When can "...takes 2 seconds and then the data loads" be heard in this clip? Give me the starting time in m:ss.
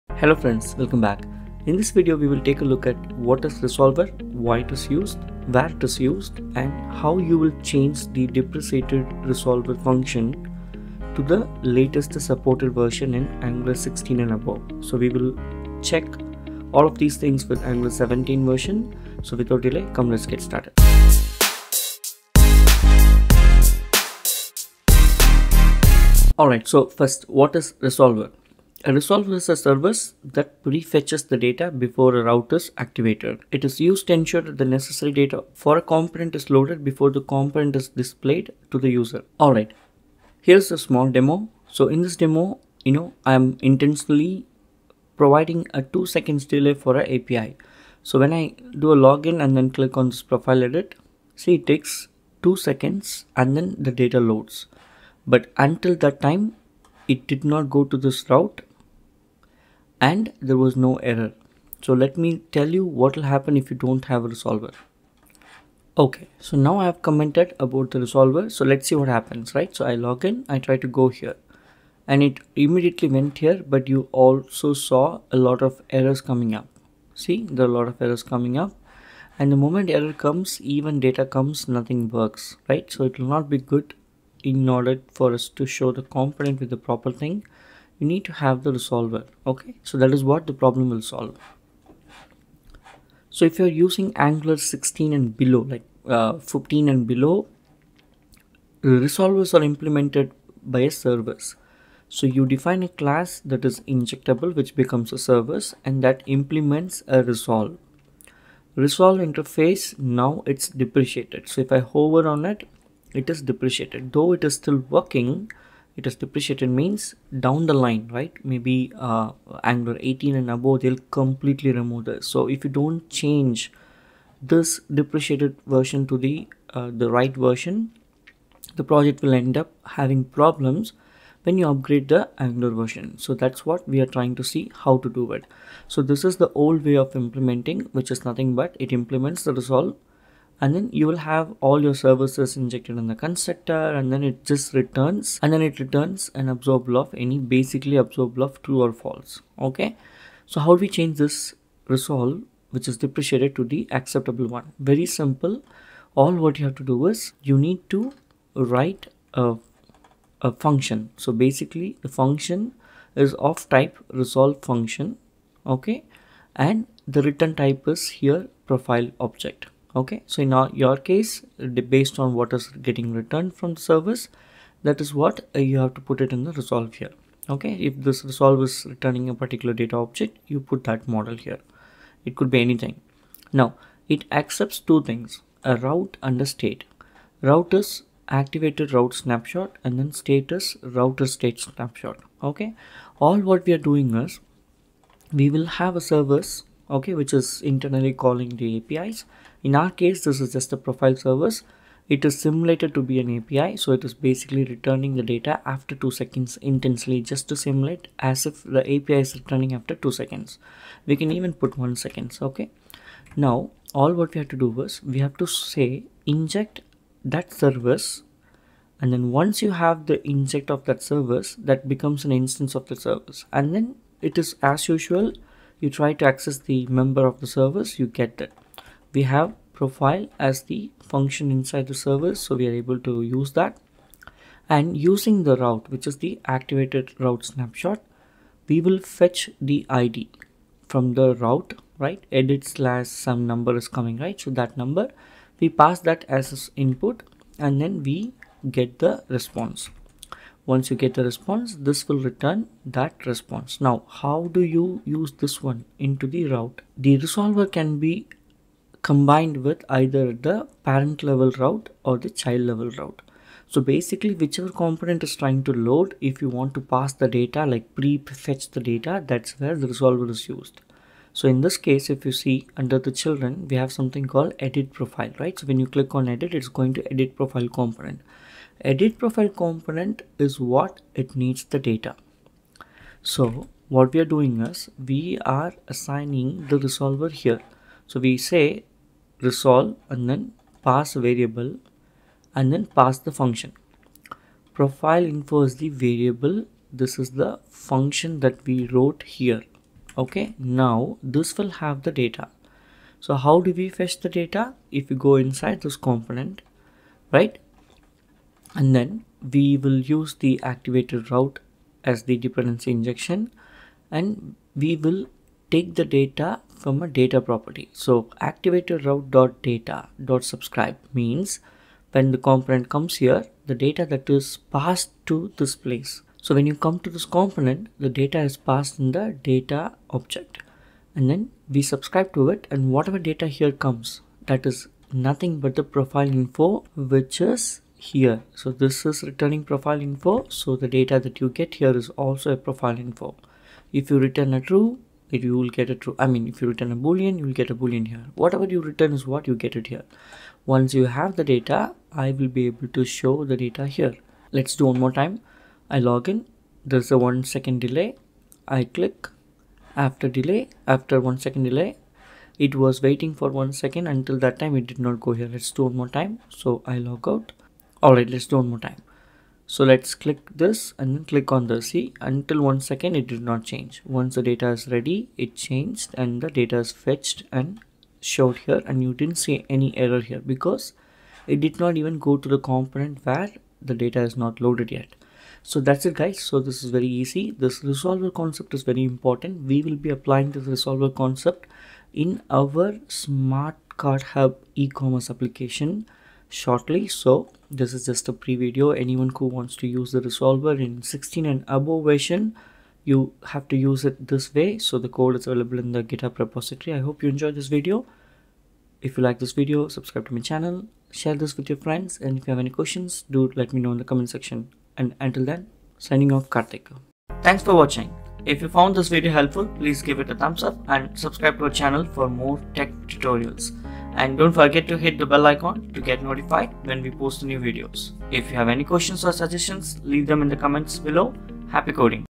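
0:51.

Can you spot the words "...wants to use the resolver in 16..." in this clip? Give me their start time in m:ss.
6:39.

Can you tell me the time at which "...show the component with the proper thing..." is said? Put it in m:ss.
1:25.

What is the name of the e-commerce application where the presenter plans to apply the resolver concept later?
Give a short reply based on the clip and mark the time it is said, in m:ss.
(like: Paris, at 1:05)
Smart Card Hub, at 6:33.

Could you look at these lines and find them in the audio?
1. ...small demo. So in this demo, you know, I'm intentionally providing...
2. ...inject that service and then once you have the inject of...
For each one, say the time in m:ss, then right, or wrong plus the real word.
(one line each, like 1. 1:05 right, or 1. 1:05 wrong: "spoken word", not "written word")
1. 0:40 right
2. 3:36 right.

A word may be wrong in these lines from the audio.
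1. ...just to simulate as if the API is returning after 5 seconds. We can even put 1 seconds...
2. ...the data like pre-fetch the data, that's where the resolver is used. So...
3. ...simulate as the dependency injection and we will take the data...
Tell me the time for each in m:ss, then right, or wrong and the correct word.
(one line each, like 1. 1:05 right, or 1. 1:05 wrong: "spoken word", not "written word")
1. 3:27 wrong: "2", not "5"
2. 4:27 right
3. 5:11 wrong: "route", not "simulate".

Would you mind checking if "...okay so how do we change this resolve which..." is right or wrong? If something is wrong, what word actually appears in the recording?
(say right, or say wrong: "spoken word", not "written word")
right.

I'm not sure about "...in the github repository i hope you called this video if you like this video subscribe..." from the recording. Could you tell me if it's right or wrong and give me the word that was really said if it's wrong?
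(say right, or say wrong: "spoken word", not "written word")
wrong: "enjoyed", not "called".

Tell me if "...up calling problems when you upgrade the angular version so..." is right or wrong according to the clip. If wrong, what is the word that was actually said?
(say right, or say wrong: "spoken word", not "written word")
wrong: "having", not "calling".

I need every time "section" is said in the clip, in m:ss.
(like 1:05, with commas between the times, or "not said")
6:54.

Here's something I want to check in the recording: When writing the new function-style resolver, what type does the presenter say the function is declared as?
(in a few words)
resolve function.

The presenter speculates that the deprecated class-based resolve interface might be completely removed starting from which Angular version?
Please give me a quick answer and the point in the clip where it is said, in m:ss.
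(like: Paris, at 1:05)
Angular 18, at 1:59.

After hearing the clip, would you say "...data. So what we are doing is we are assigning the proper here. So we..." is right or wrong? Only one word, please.
wrong.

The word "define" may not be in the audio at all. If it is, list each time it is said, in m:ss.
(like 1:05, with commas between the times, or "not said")
1:42.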